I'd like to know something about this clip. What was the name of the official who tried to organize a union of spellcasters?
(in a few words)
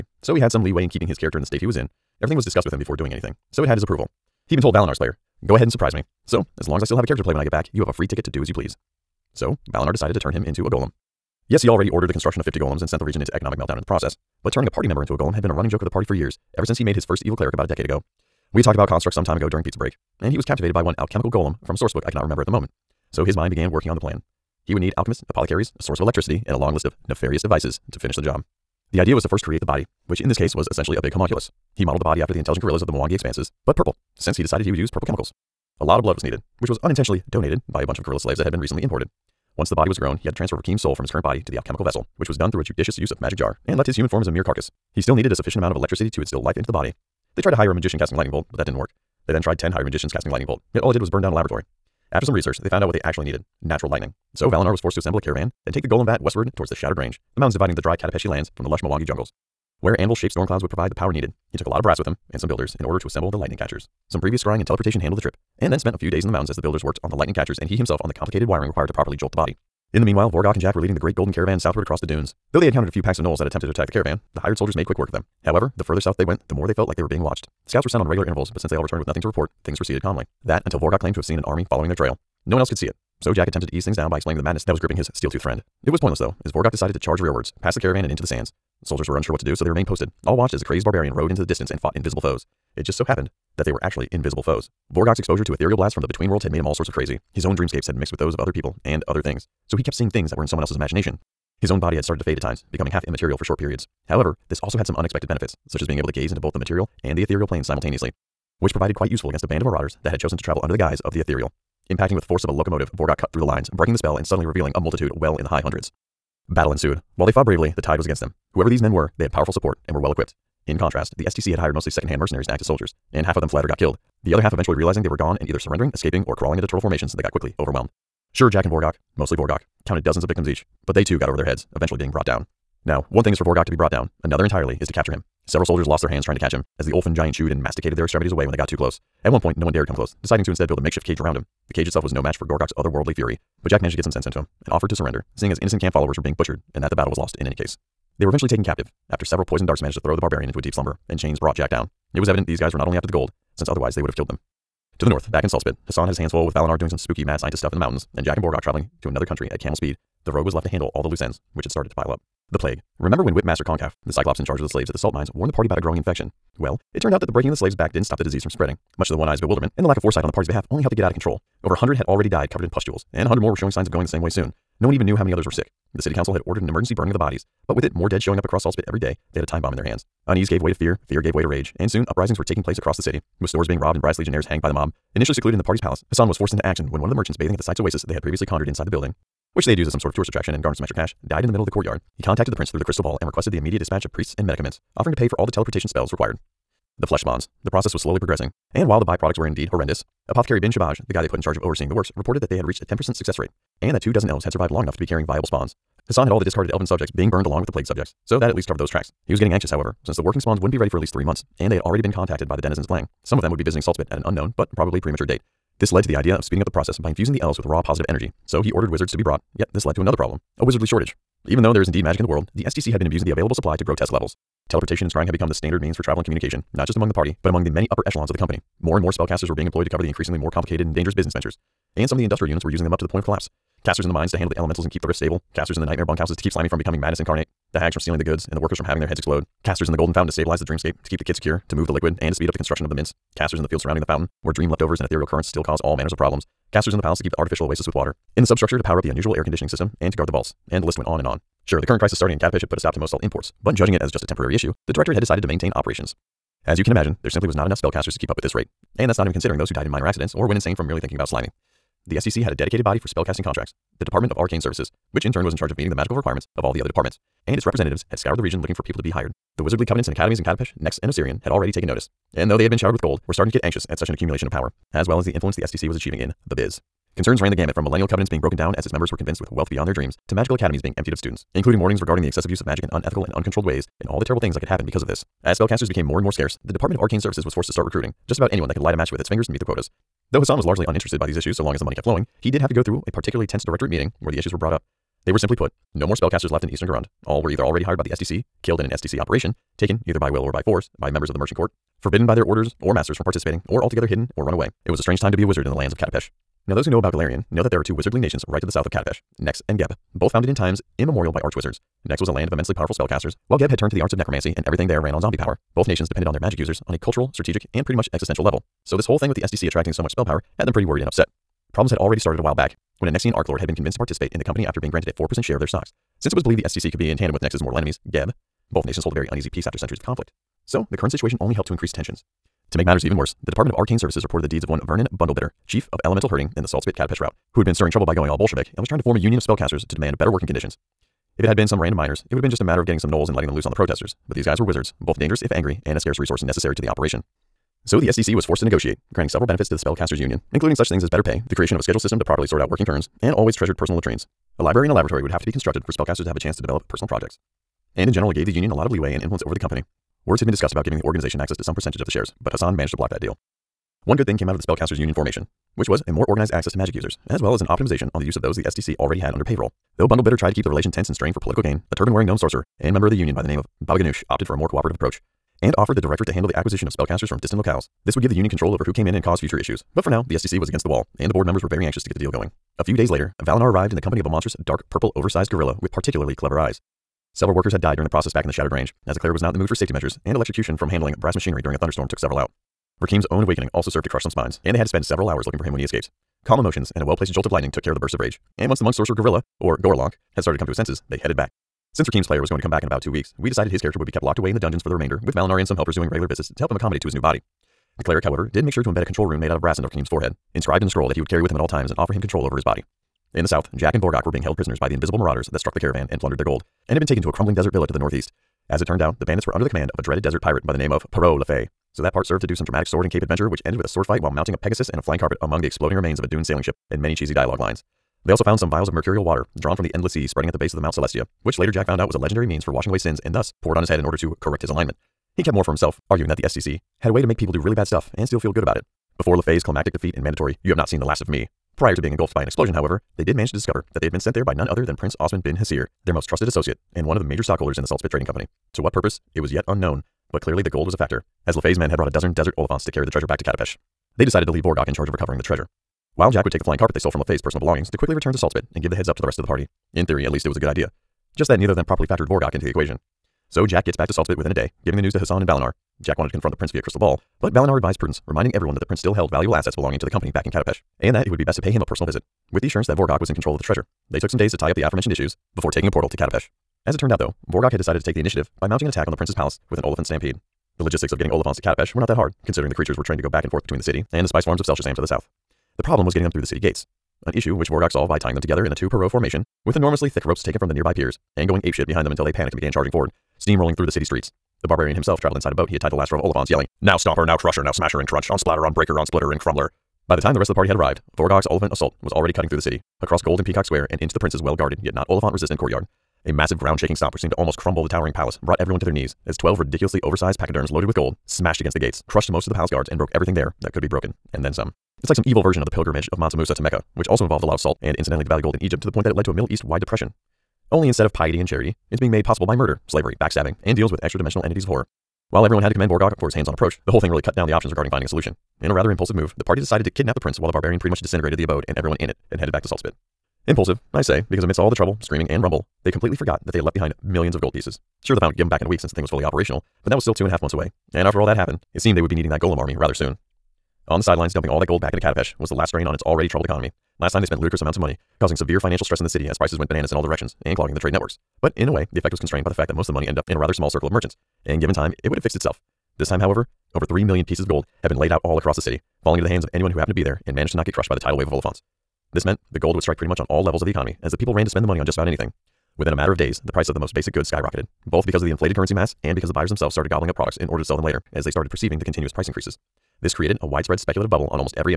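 Vernon Bundlebitter.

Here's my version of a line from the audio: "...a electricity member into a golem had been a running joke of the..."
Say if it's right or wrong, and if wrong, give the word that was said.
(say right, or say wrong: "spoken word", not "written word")
wrong: "party", not "electricity".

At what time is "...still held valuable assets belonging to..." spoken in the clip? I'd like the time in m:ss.
7:48.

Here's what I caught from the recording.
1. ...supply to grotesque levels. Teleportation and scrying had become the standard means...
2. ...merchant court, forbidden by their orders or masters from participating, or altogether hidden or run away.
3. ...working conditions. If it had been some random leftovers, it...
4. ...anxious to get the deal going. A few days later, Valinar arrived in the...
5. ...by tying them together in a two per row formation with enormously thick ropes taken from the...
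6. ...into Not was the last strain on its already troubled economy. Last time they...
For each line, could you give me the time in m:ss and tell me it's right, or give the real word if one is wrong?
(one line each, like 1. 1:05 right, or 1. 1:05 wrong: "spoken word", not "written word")
1. 3:43 right
2. 5:01 right
3. 5:40 wrong: "miners", not "leftovers"
4. 6:21 right
5. 8:08 right
6. 9:04 wrong: "Katapesh", not "Not".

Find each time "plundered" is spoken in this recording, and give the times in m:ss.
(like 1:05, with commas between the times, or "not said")
6:56.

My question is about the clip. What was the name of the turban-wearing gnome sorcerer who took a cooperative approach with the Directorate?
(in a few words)
Baba Ganoush.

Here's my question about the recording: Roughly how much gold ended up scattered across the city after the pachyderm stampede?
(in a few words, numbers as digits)
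over 3 million gold pieces.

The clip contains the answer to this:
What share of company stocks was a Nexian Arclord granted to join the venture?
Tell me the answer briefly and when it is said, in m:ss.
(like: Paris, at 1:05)
4%, at 5:25.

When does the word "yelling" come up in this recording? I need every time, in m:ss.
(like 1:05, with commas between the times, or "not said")
8:16.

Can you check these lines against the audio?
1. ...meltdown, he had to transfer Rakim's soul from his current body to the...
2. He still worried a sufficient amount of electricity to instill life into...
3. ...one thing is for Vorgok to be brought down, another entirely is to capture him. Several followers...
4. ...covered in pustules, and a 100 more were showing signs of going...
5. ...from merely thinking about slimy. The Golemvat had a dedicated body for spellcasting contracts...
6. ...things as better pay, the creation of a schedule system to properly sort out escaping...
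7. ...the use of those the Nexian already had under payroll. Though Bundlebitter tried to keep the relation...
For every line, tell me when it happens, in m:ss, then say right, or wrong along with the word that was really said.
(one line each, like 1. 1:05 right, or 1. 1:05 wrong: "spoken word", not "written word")
1. 0:39 wrong: "grown", not "meltdown"
2. 0:44 wrong: "needed", not "worried"
3. 2:13 wrong: "soldiers", not "followers"
4. 2:52 right
5. 4:20 wrong: "STC", not "Golemvat"
6. 5:50 wrong: "working", not "escaping"
7. 6:08 wrong: "STC", not "Nexian".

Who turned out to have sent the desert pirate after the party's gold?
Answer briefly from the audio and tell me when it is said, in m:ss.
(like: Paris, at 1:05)
Prince Osman bin Hasir, at 7:24.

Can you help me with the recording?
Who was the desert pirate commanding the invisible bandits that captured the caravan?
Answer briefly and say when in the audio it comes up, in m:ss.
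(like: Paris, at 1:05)
Perrault Le Fay, at 7:01.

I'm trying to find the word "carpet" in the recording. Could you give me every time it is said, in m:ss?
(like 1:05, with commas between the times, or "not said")
7:05, 7:36.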